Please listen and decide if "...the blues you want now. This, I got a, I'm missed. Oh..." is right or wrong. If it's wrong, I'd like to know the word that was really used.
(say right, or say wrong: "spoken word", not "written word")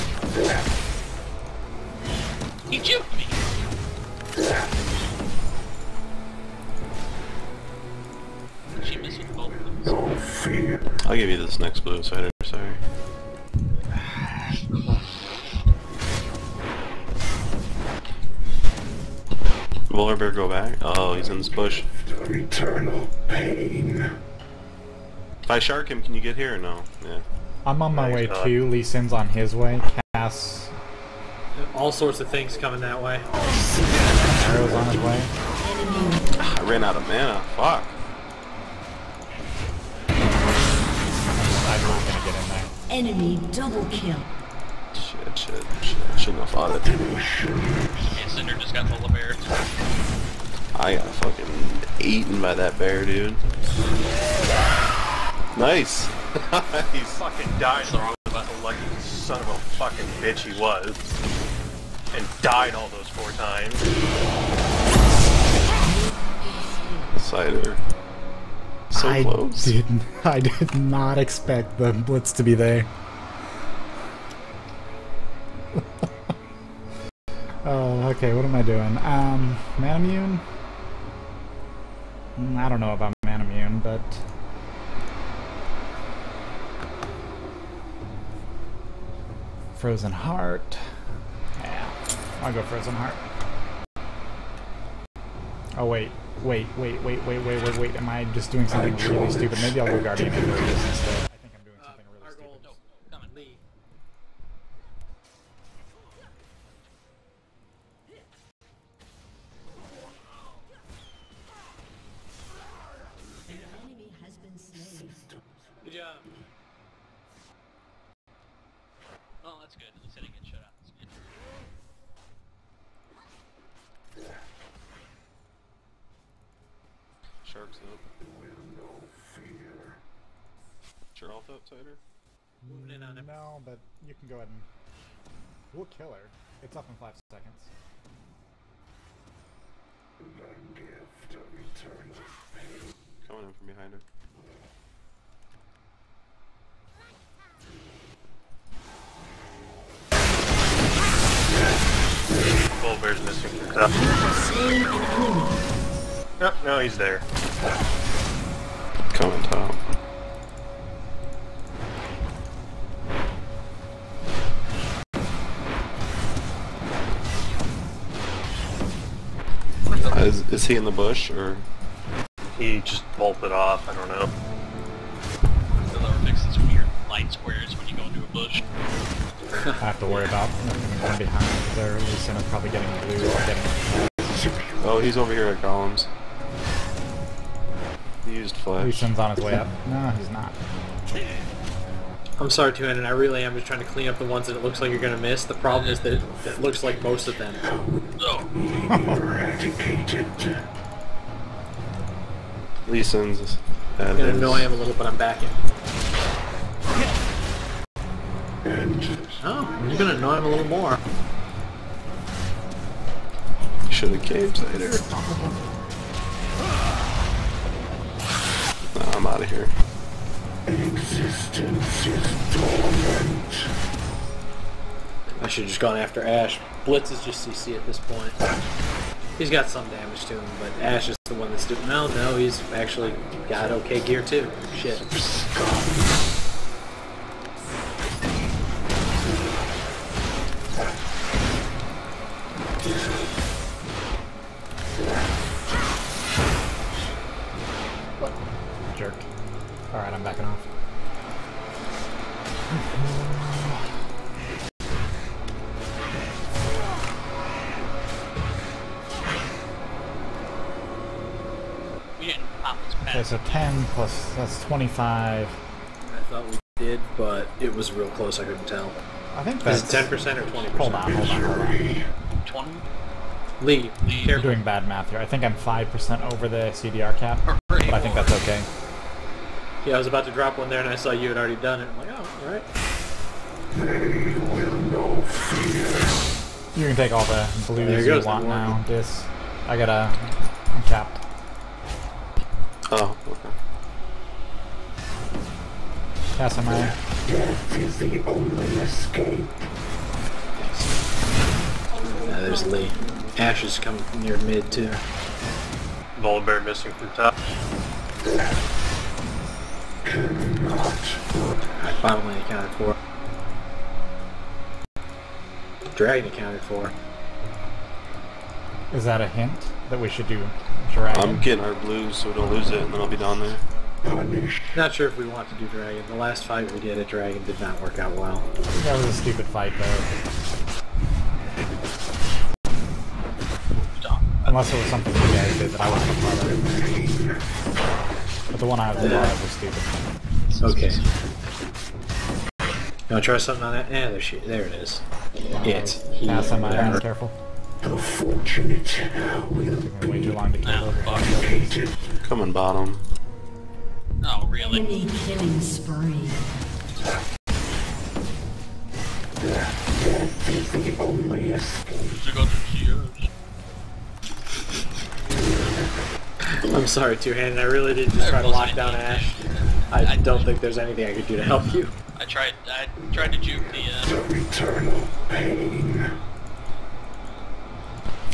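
wrong: "capped", not "missed".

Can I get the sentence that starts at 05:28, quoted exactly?
That was a stupid fight, though.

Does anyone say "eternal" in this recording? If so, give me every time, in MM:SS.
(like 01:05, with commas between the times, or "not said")
00:22, 02:21, 06:14.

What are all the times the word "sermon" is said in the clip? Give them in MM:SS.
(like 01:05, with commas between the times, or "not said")
not said.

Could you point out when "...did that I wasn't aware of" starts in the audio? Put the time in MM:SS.
05:35.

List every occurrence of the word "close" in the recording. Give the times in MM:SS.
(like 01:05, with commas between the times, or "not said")
01:09, 04:28.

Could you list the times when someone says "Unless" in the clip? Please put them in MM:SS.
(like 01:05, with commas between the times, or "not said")
05:34.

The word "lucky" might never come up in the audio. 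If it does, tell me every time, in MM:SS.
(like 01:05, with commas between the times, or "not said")
00:58.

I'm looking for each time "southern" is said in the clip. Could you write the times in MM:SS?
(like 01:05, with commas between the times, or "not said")
not said.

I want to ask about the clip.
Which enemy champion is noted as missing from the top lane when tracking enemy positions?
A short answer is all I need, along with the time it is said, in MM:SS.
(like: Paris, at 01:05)
Volibear, at 05:06.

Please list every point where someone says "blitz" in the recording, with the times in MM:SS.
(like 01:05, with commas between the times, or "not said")
01:11, 03:46.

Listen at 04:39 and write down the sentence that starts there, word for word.
Yeah, I was about to drop one there and I saw you had already done it.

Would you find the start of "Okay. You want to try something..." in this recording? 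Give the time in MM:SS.
05:40.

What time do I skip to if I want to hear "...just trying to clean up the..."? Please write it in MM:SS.
03:13.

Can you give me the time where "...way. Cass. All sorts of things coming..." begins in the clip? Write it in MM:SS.
00:29.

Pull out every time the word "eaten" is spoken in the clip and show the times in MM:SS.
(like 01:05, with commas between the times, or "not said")
00:52.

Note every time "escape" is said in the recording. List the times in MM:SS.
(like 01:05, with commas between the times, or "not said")
04:58, 06:01.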